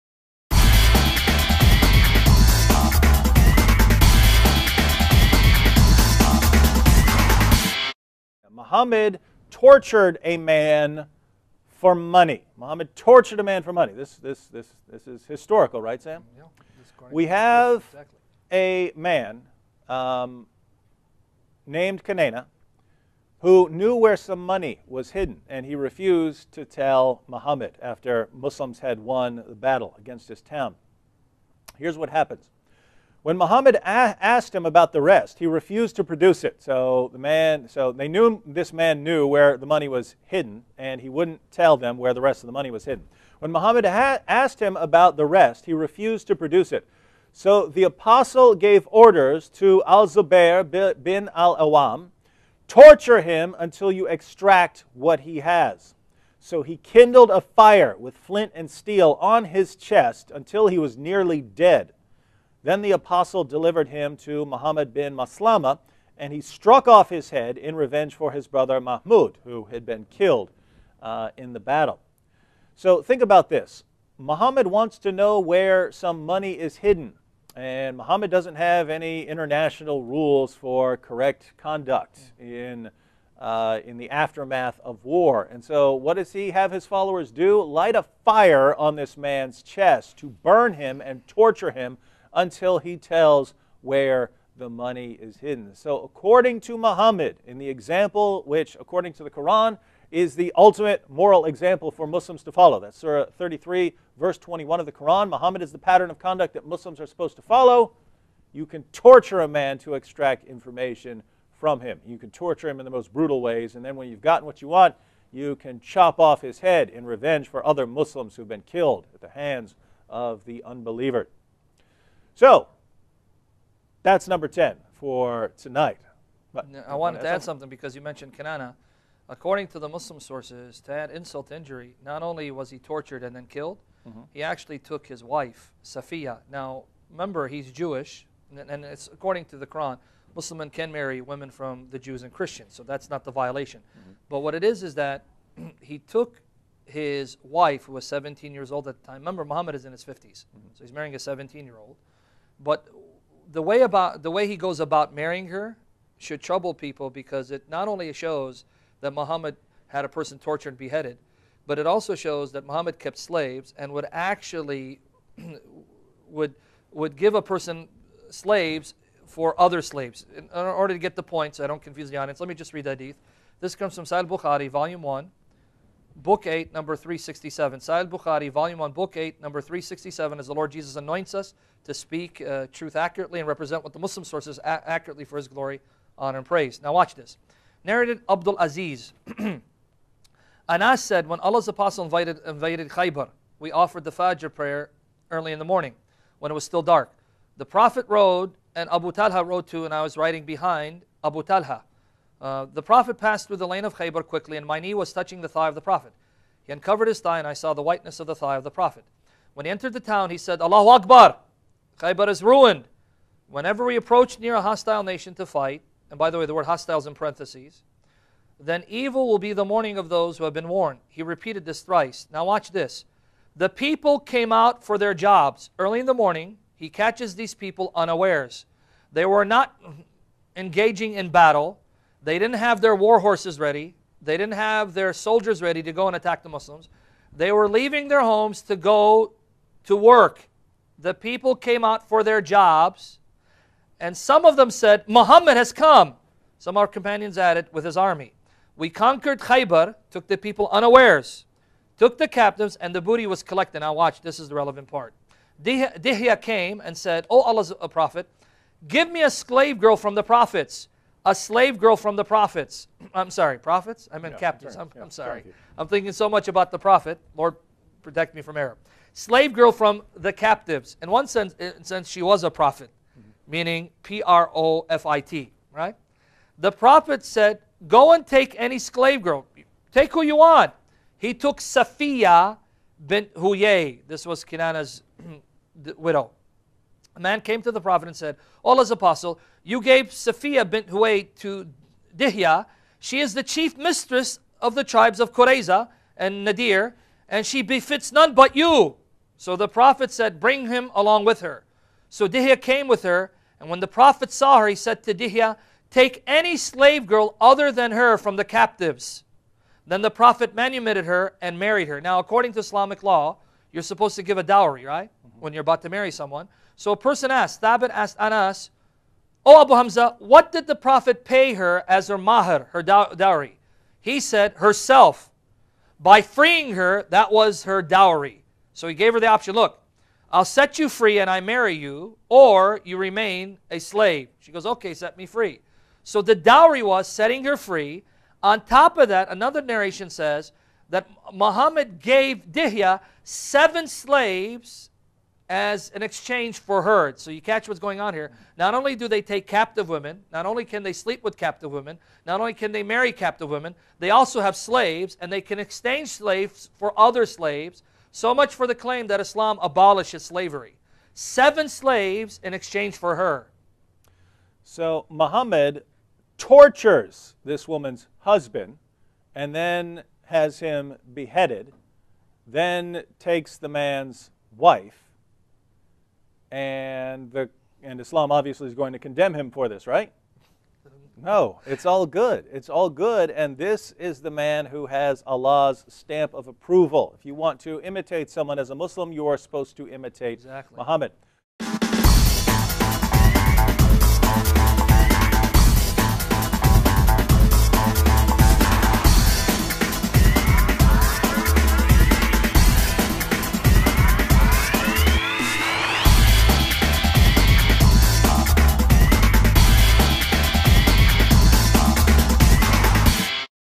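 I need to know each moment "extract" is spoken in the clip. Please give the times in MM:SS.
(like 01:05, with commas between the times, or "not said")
00:54, 01:49.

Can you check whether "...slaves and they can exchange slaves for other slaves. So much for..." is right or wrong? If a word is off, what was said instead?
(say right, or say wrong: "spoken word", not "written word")
right.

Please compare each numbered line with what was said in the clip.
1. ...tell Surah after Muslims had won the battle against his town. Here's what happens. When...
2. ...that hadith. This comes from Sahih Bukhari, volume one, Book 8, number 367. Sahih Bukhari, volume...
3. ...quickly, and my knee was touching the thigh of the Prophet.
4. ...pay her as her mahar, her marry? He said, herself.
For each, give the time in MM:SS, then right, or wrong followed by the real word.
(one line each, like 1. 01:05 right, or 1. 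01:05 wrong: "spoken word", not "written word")
1. 00:26 wrong: "Muhammad", not "Surah"
2. 02:52 right
3. 03:24 right
4. 05:21 wrong: "dowry", not "marry".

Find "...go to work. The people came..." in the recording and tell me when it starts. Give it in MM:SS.
03:58.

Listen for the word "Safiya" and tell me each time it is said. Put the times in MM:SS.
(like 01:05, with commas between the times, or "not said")
02:15, 04:41, 04:50.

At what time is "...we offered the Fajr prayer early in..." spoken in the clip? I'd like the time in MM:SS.
03:13.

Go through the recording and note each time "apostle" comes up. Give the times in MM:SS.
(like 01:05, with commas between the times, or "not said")
00:47, 01:02, 03:11, 04:48.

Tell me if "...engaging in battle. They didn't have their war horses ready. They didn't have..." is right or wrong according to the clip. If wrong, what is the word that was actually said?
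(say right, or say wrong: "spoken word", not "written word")
right.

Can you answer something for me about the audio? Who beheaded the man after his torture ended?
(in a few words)
Muhammad bin Maslama.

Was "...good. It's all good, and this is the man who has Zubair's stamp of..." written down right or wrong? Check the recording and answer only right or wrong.
wrong.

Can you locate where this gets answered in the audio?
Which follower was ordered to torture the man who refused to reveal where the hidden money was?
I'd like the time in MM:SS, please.
00:49.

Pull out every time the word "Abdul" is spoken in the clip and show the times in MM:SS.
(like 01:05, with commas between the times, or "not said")
03:08.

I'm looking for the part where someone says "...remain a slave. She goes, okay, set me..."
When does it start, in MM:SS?
05:32.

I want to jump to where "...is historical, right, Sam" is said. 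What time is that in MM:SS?
00:15.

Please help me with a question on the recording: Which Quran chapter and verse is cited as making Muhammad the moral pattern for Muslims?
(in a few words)
Surah 33, verse 21.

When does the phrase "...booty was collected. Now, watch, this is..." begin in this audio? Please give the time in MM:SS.
04:13.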